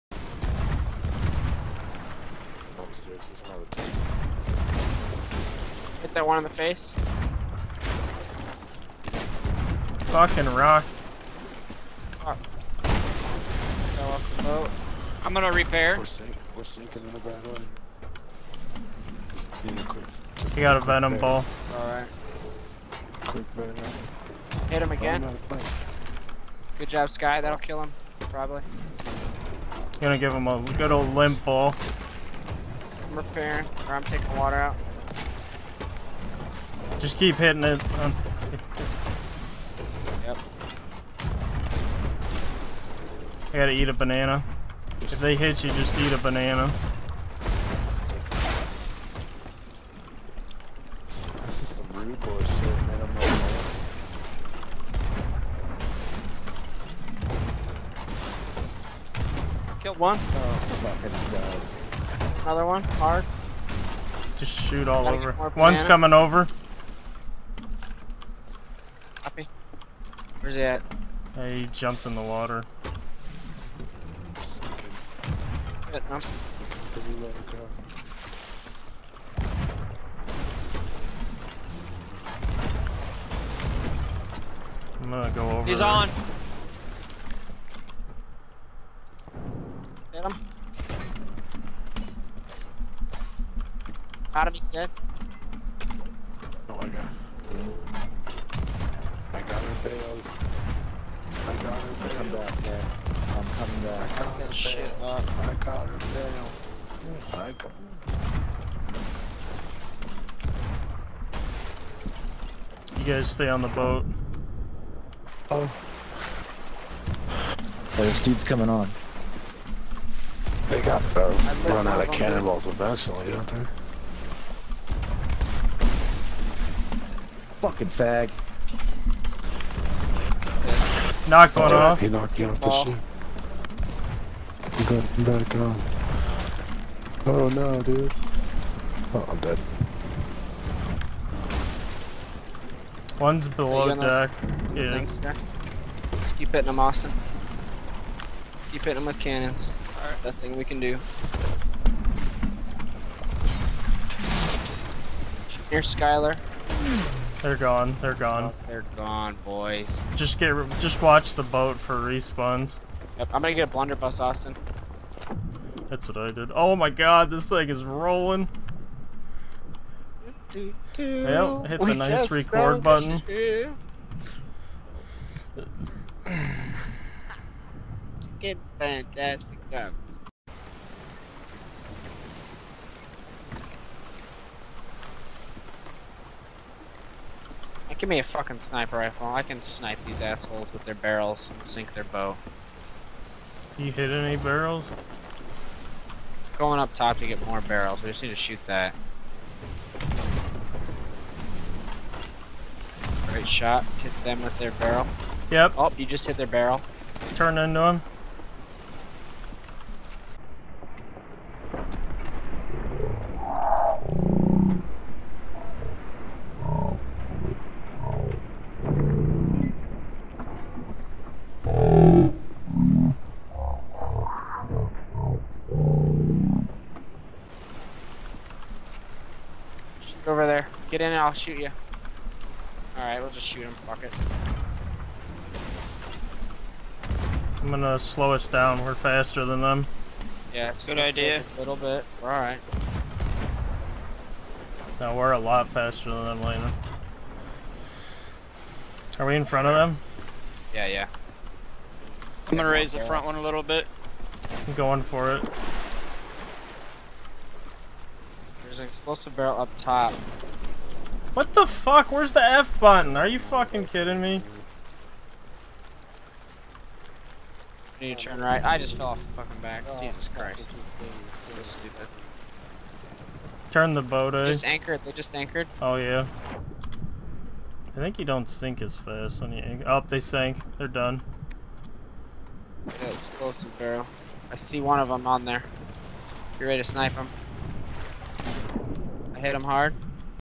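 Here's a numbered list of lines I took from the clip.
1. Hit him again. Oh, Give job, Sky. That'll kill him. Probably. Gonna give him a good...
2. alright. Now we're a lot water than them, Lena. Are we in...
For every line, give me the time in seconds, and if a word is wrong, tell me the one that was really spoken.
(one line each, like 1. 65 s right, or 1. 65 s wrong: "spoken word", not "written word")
1. 24 s wrong: "Good", not "Give"
2. 242 s wrong: "faster", not "water".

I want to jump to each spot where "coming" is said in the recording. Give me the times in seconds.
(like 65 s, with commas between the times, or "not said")
65 s, 103 s, 118 s.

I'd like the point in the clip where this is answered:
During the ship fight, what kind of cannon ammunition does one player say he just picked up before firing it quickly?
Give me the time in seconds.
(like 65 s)
20 s.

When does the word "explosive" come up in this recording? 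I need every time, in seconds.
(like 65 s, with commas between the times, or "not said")
258 s, 283 s.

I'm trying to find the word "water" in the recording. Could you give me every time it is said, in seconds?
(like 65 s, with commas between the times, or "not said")
34 s, 72 s.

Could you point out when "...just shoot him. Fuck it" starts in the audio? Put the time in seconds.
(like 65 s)
233 s.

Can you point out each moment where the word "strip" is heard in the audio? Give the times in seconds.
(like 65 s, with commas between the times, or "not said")
not said.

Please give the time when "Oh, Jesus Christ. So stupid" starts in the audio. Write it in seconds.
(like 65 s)
269 s.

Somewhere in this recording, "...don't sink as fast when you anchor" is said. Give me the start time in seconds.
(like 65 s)
278 s.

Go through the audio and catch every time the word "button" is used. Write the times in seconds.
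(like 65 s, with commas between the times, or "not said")
172 s, 262 s.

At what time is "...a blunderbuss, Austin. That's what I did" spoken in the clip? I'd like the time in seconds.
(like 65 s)
163 s.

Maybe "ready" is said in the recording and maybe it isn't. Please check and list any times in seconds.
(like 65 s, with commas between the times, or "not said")
286 s.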